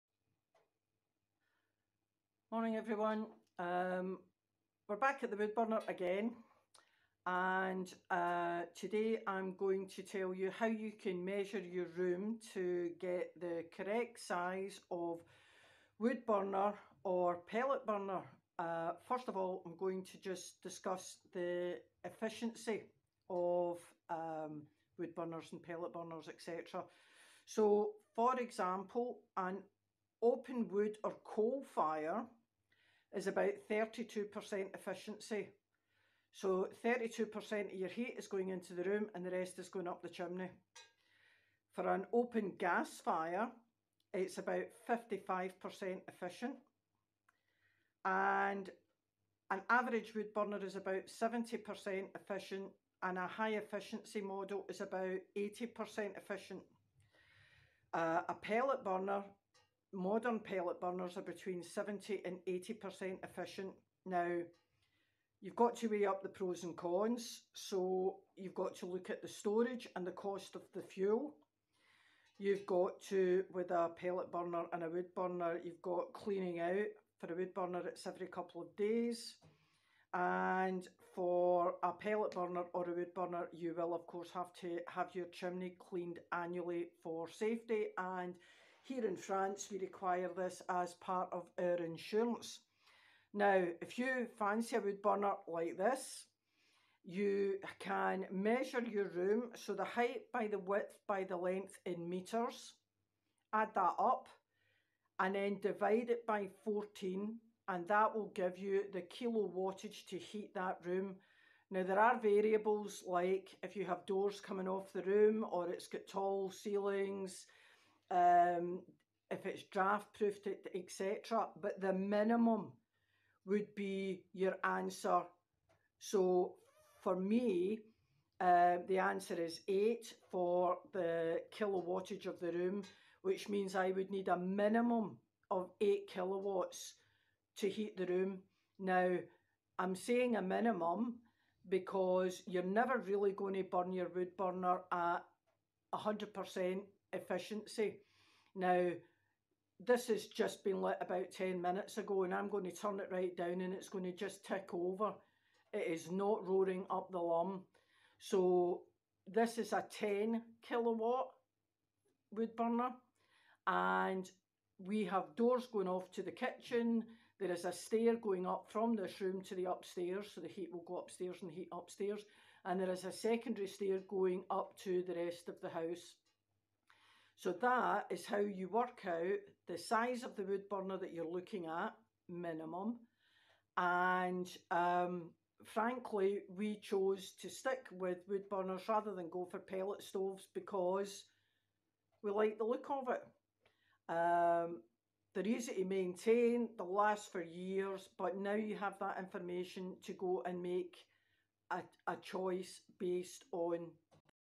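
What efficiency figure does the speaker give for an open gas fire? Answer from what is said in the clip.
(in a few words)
55%.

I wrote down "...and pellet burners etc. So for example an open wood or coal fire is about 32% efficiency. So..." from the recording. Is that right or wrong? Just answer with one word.
right.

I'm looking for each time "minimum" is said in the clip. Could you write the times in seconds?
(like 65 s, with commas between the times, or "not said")
121 s, 134 s, 140 s, 182 s.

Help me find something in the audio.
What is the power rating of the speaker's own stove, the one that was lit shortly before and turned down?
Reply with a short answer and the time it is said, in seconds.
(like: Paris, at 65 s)
10 kilowatts, at 159 s.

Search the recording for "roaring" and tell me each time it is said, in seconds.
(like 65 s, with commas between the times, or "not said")
156 s.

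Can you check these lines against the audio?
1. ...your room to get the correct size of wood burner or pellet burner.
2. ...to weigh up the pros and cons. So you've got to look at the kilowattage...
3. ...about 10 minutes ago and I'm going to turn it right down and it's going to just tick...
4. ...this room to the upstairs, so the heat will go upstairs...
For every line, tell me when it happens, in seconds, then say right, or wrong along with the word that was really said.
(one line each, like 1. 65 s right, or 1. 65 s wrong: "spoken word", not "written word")
1. 11 s right
2. 65 s wrong: "storage", not "kilowattage"
3. 151 s right
4. 168 s right.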